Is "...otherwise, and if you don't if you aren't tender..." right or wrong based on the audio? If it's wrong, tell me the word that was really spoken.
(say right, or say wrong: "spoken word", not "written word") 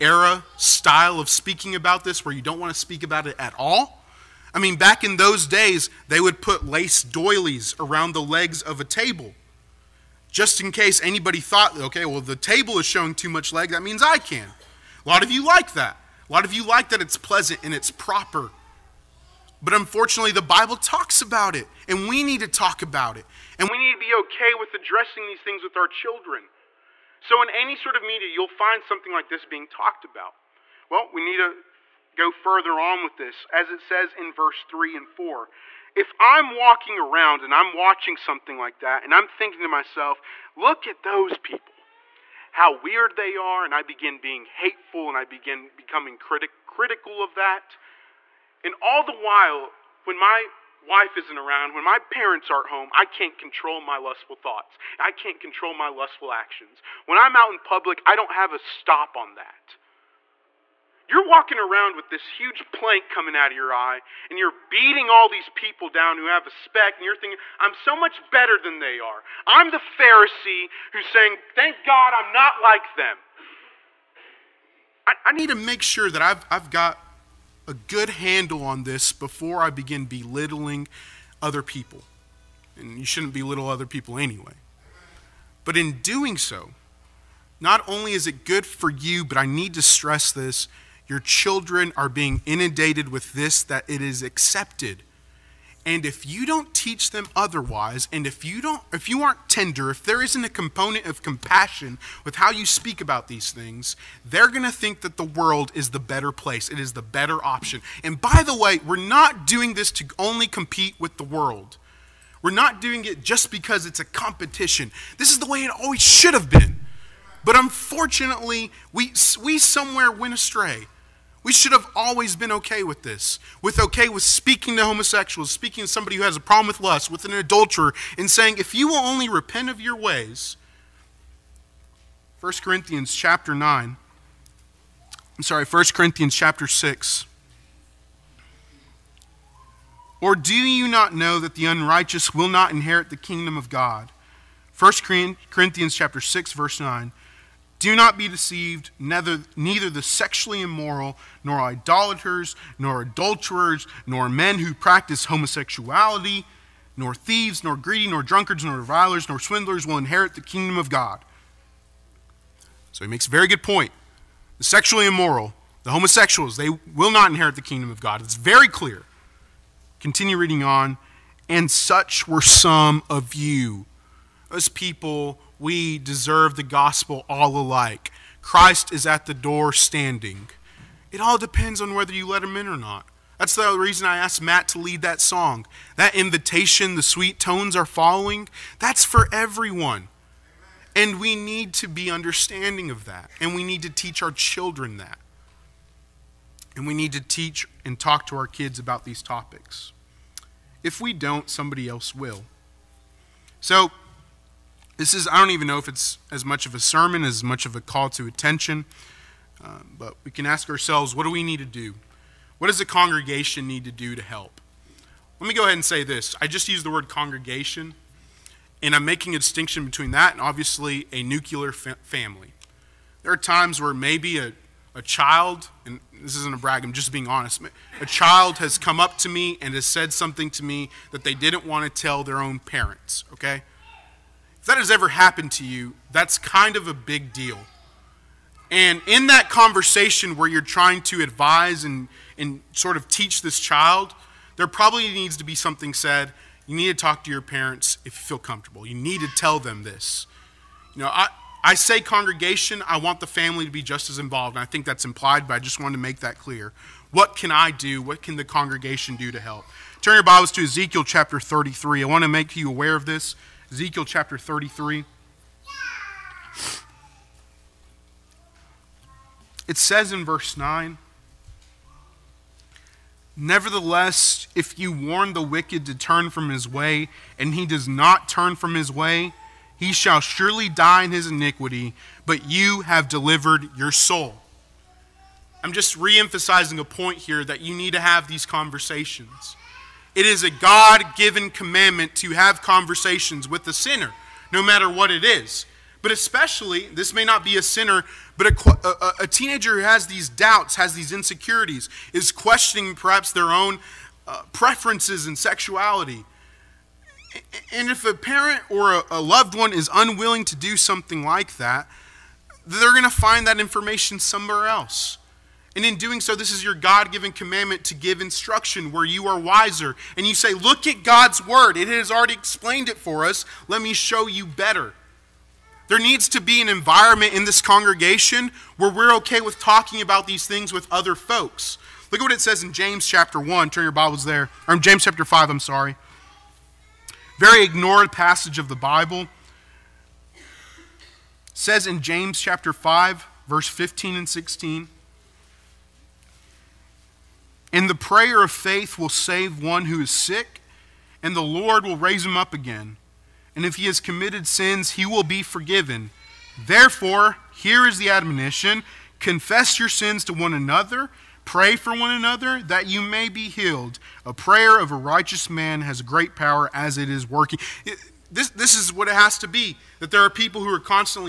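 right.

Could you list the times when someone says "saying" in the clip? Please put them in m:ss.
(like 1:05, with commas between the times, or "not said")
1:11, 2:08.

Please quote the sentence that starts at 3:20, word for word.
If we don't, somebody else will.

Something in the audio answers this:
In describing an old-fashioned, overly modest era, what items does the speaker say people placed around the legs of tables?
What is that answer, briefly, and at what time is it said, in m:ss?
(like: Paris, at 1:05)
lace doilies, at 0:06.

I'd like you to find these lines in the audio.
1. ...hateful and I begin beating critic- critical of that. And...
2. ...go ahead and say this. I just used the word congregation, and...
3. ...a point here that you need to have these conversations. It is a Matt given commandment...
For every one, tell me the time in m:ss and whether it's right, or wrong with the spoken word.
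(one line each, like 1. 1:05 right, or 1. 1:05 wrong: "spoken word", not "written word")
1. 0:44 wrong: "becoming", not "beating"
2. 3:35 right
3. 4:46 wrong: "God", not "Matt".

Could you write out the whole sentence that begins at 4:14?
And I think that's implied, but I just wanted to make that clear.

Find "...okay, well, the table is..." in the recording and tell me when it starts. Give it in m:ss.
0:11.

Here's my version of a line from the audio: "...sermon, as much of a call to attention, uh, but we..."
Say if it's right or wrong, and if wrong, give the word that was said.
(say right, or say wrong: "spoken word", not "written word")
right.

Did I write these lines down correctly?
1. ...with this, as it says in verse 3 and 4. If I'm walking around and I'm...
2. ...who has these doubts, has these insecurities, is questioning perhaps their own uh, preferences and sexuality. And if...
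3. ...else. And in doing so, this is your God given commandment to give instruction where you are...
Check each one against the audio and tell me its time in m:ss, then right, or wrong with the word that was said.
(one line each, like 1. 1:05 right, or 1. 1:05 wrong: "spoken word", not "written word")
1. 0:33 right
2. 4:59 right
3. 5:14 right.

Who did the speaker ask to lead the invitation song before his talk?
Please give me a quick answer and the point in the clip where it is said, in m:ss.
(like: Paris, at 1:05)
Matt, at 3:04.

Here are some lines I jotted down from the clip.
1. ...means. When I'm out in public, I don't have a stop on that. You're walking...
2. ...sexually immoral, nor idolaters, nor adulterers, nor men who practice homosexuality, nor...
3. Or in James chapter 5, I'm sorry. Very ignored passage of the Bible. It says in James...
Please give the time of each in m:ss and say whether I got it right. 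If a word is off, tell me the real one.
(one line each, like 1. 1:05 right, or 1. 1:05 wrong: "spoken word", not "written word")
1. 0:56 wrong: "actions", not "means"
2. 2:30 right
3. 5:34 right.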